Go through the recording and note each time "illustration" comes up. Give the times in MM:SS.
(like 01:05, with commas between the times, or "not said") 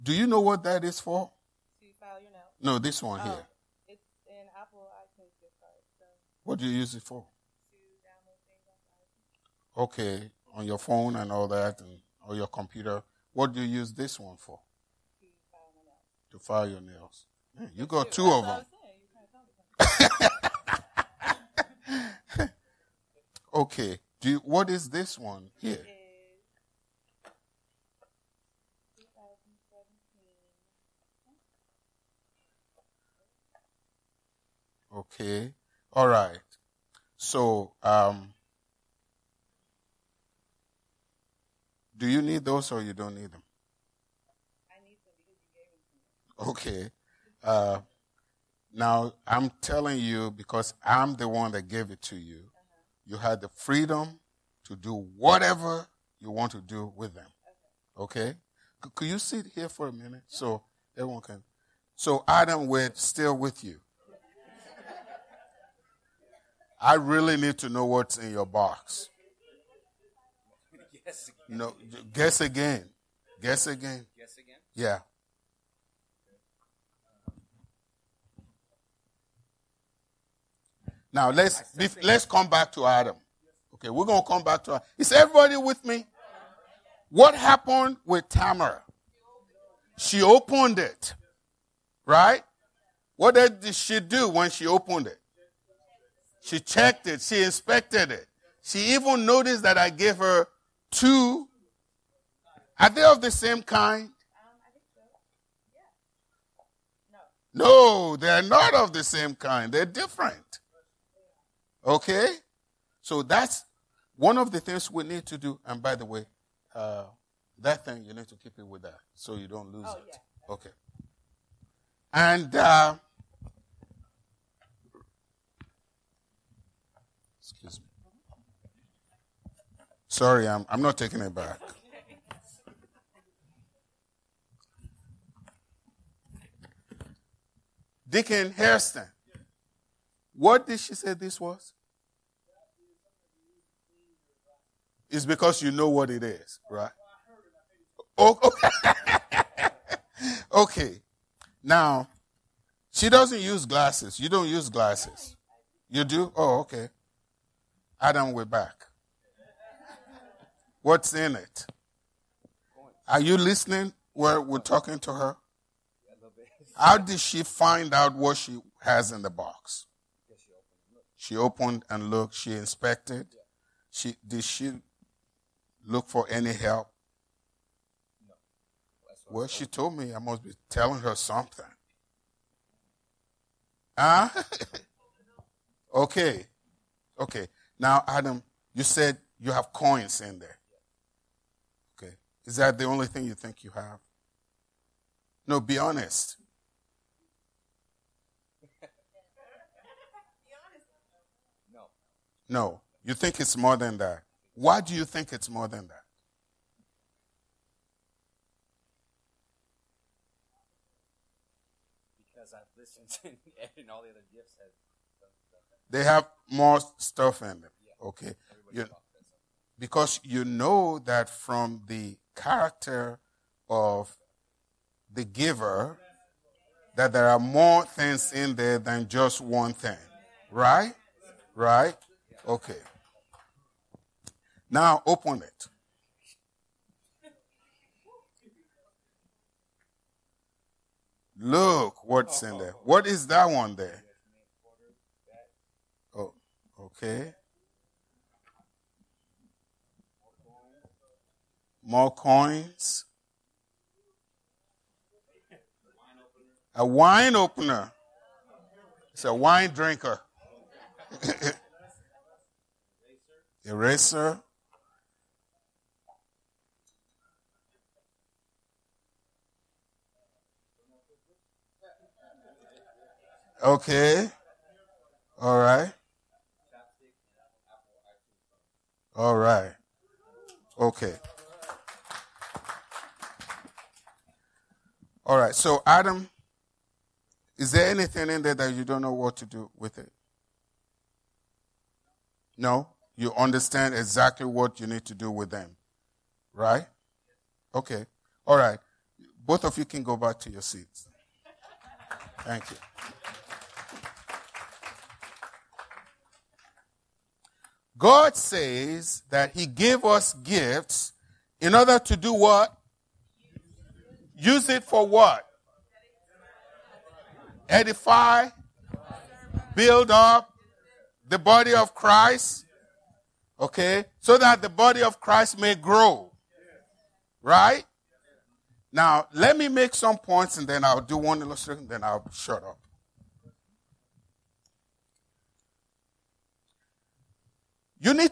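05:31.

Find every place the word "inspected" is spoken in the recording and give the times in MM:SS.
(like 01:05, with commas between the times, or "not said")
01:37, 02:52.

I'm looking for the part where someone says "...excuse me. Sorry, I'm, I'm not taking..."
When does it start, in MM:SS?
02:07.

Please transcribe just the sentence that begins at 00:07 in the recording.
To download things on Okay, on your phone and all that, and or your computer.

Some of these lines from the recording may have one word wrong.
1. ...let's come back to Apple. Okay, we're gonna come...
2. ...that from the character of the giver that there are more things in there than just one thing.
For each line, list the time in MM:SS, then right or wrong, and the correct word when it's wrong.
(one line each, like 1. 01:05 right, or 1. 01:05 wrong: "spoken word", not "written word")
1. 01:22 wrong: "Adam", not "Apple"
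2. 03:40 right.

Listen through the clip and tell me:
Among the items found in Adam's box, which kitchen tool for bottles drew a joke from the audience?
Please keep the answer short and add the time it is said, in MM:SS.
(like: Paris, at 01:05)
Wine opener, at 04:16.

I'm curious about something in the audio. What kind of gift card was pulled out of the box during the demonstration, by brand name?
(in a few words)
Apple iTunes.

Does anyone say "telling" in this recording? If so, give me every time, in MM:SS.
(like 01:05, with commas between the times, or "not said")
00:49, 03:00.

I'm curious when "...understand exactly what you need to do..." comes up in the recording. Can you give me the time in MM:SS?
04:53.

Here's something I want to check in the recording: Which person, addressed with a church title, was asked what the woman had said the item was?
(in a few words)
Deacon Hairston.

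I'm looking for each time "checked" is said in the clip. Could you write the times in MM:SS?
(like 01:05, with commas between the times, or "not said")
01:36.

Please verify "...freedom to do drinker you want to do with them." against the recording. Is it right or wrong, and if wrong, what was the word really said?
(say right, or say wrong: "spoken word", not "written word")
wrong: "whatever", not "drinker".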